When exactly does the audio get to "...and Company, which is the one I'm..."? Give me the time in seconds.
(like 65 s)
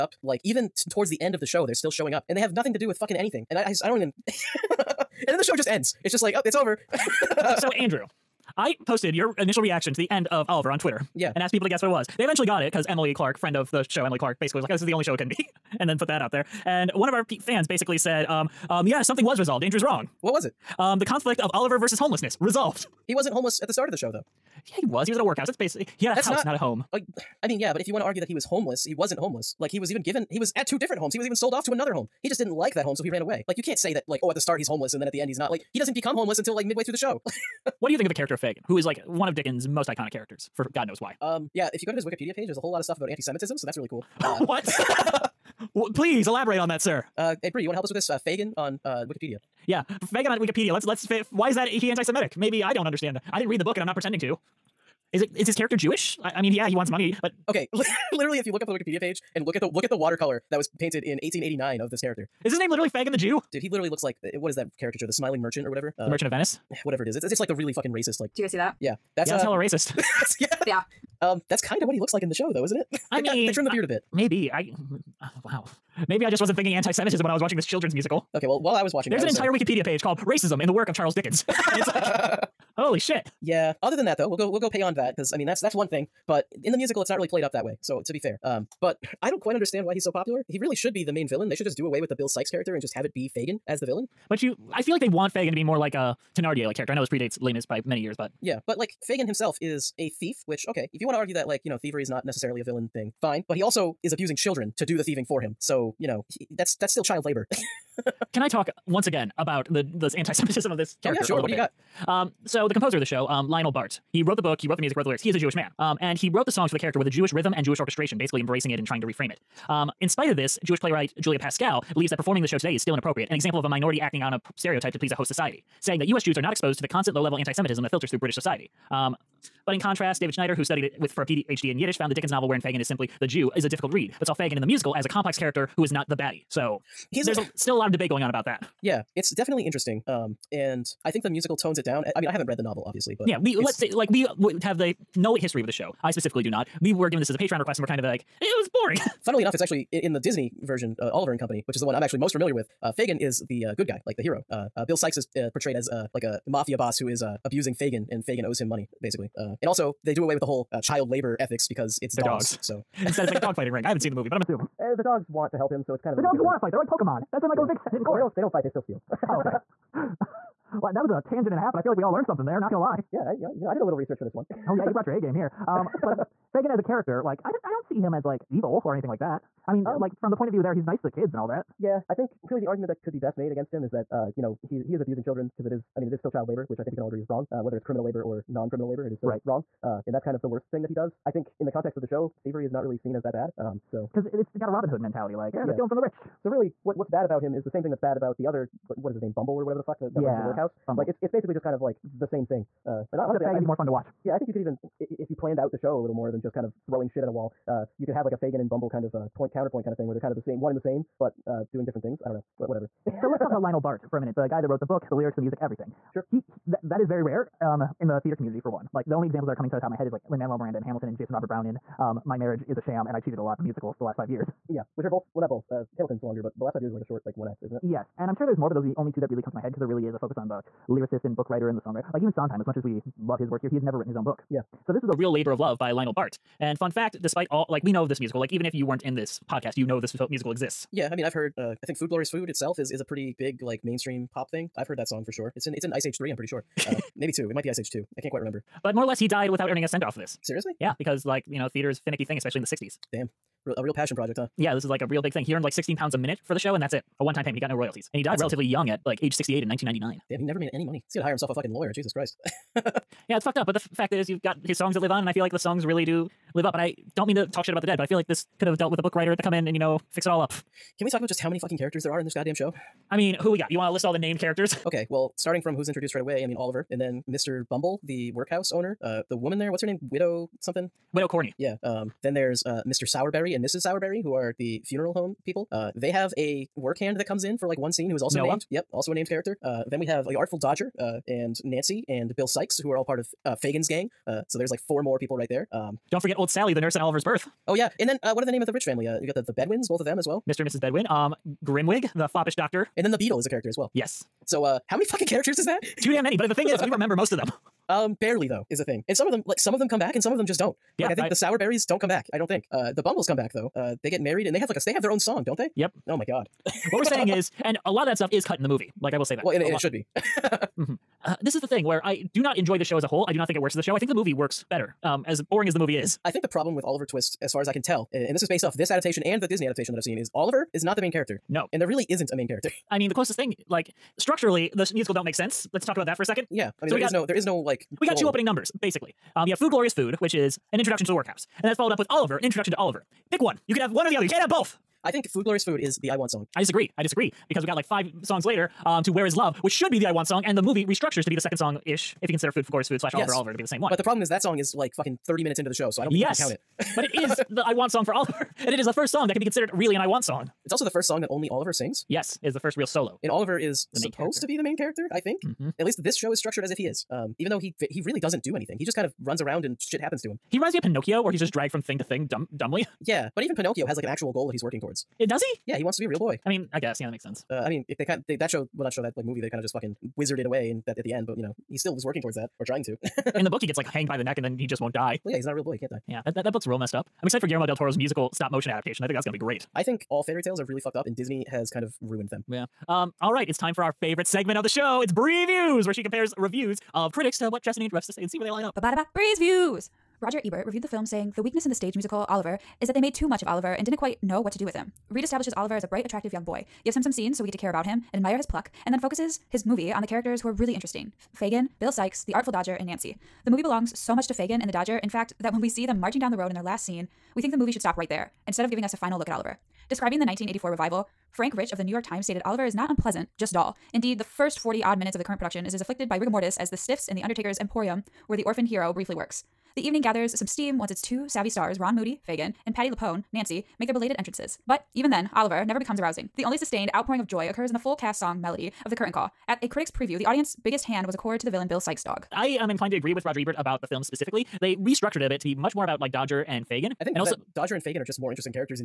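151 s.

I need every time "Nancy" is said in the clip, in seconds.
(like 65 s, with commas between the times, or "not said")
291 s, 412 s, 433 s.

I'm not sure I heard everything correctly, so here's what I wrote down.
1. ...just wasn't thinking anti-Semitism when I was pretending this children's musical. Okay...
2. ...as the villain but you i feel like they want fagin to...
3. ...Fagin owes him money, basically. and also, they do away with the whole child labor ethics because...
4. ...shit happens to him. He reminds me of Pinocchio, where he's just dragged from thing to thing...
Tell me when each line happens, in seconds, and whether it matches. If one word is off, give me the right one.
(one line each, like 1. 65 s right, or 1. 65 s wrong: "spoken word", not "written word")
1. 76 s wrong: "watching", not "pretending"
2. 93 s right
3. 158 s right
4. 369 s right.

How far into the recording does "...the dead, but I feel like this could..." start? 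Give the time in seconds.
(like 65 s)
267 s.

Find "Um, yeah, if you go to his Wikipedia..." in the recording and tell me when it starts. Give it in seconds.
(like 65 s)
41 s.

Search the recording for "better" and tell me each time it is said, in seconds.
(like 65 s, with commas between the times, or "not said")
324 s.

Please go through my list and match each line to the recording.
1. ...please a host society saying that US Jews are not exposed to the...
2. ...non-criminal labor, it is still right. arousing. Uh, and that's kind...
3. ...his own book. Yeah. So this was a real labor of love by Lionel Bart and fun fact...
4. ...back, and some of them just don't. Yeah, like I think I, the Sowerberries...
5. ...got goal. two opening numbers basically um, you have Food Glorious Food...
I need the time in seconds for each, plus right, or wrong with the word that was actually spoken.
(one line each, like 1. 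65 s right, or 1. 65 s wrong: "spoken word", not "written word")
1. 124 s right
2. 188 s wrong: "wrong", not "arousing"
3. 234 s right
4. 309 s right
5. 338 s right.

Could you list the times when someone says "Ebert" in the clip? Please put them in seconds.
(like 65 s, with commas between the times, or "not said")
400 s, 443 s.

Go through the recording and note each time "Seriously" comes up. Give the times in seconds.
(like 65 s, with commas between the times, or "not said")
250 s.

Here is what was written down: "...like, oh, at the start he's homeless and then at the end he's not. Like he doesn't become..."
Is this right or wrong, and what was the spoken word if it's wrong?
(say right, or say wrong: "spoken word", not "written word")
right.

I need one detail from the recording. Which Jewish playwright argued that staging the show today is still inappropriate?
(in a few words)
Julia Pascal.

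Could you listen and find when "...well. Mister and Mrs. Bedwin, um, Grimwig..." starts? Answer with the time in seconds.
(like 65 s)
300 s.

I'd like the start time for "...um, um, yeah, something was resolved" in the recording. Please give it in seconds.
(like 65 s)
18 s.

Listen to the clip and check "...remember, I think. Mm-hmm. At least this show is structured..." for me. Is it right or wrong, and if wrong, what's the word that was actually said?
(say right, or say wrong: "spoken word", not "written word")
wrong: "character", not "remember".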